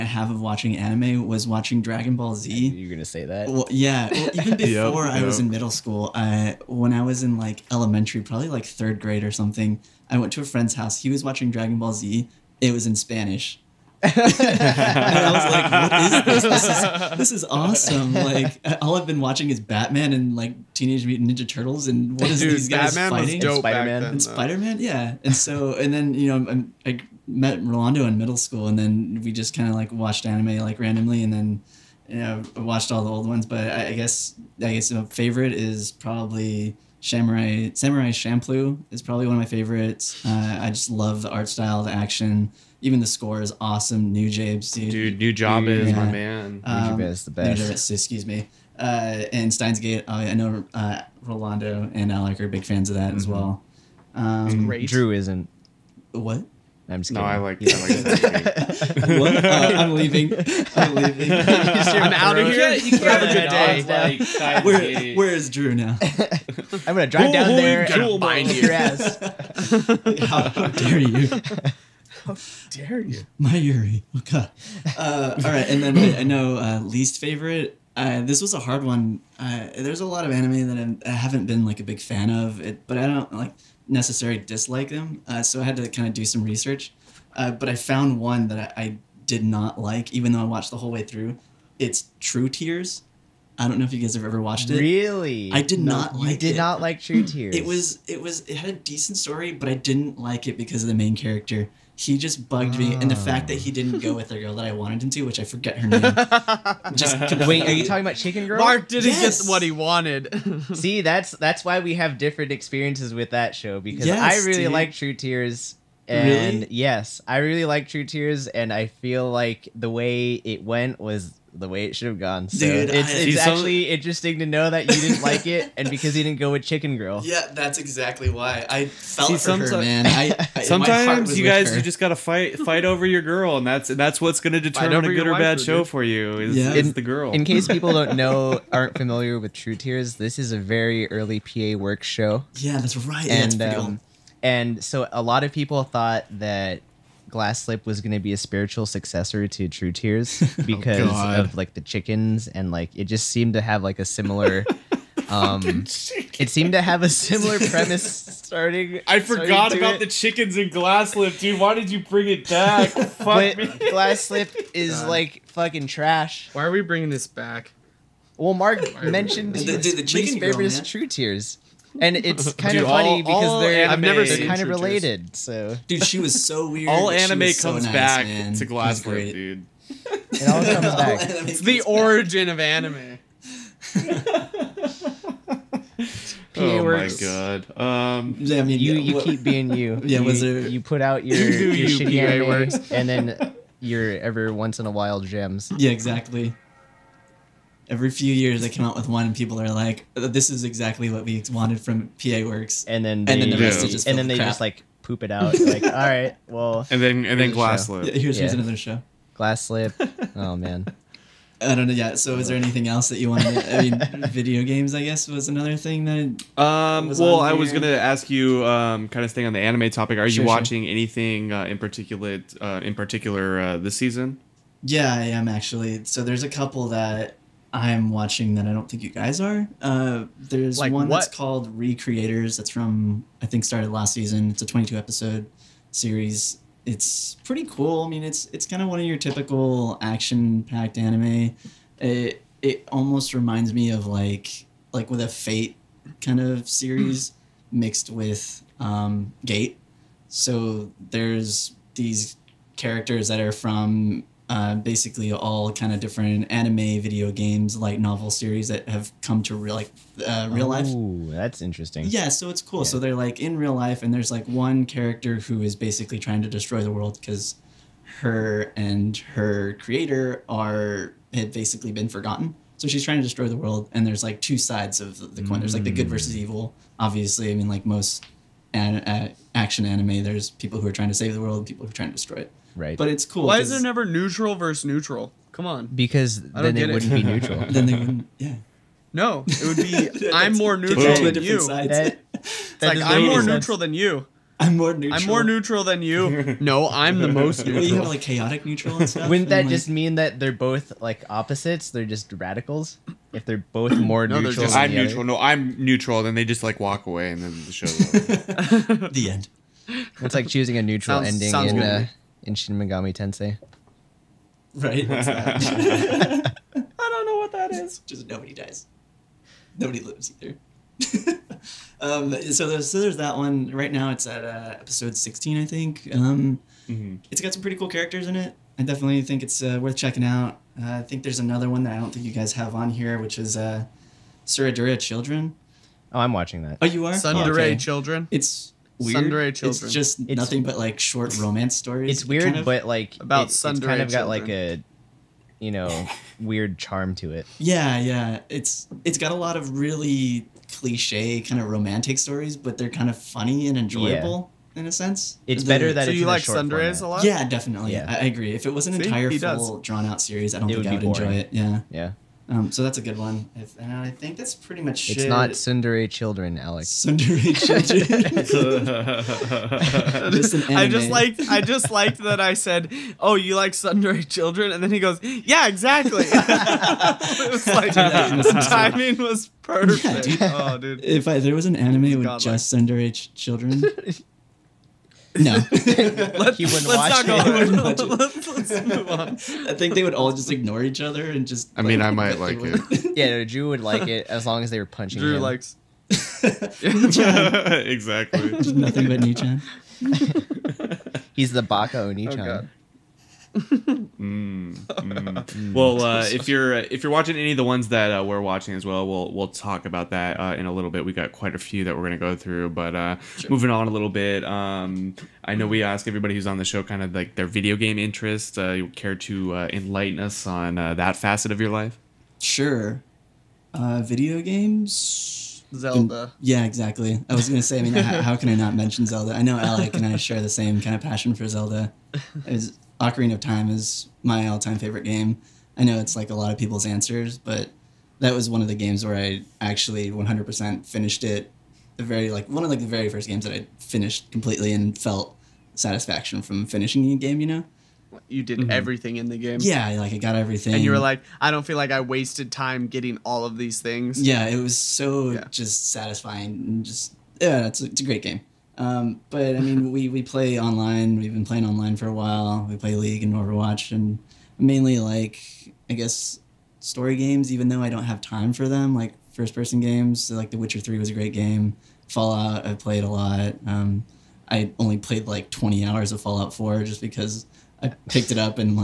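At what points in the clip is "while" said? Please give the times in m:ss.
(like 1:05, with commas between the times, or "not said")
3:14, 7:42.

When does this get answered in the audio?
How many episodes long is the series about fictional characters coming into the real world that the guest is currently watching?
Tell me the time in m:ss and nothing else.
3:54.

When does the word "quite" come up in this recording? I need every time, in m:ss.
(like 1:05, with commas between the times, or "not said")
6:51.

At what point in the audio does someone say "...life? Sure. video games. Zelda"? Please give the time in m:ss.
7:01.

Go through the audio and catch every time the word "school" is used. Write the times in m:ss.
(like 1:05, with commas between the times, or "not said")
0:05, 0:28.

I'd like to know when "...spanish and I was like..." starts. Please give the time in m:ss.
0:12.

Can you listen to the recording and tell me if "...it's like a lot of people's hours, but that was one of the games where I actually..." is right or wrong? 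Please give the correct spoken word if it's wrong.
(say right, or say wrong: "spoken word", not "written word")
wrong: "answers", not "hours".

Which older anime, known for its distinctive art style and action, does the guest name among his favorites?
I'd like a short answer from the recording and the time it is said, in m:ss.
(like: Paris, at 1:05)
Samurai Champloo, at 0:37.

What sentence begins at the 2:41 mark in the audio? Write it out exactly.
Why did you bring it back?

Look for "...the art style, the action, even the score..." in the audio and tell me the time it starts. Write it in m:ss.
0:41.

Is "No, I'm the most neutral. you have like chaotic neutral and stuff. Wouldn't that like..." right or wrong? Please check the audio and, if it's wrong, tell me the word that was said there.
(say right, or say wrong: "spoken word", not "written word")
right.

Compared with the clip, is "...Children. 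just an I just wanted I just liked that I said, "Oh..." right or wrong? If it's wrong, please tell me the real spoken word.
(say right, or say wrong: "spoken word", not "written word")
wrong: "liked", not "wanted".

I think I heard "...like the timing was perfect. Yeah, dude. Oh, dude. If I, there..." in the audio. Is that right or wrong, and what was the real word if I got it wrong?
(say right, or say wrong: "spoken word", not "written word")
right.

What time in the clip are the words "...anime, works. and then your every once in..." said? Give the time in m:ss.
3:12.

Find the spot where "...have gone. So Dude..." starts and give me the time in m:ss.
2:02.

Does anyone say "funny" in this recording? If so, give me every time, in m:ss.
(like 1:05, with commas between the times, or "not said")
2:52, 5:53.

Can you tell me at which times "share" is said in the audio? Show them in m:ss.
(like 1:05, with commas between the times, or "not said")
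7:10.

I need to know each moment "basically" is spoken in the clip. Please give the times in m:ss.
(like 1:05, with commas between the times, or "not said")
4:14, 4:25, 4:31.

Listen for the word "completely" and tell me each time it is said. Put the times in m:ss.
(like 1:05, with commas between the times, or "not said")
7:24.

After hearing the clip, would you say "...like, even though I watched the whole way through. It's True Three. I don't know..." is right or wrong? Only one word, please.
wrong.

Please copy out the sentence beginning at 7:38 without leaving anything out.
Um, but I mean, we, we play online.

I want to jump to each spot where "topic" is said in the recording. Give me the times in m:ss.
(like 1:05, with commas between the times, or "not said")
3:39.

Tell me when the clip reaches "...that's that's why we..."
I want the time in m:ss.
1:51.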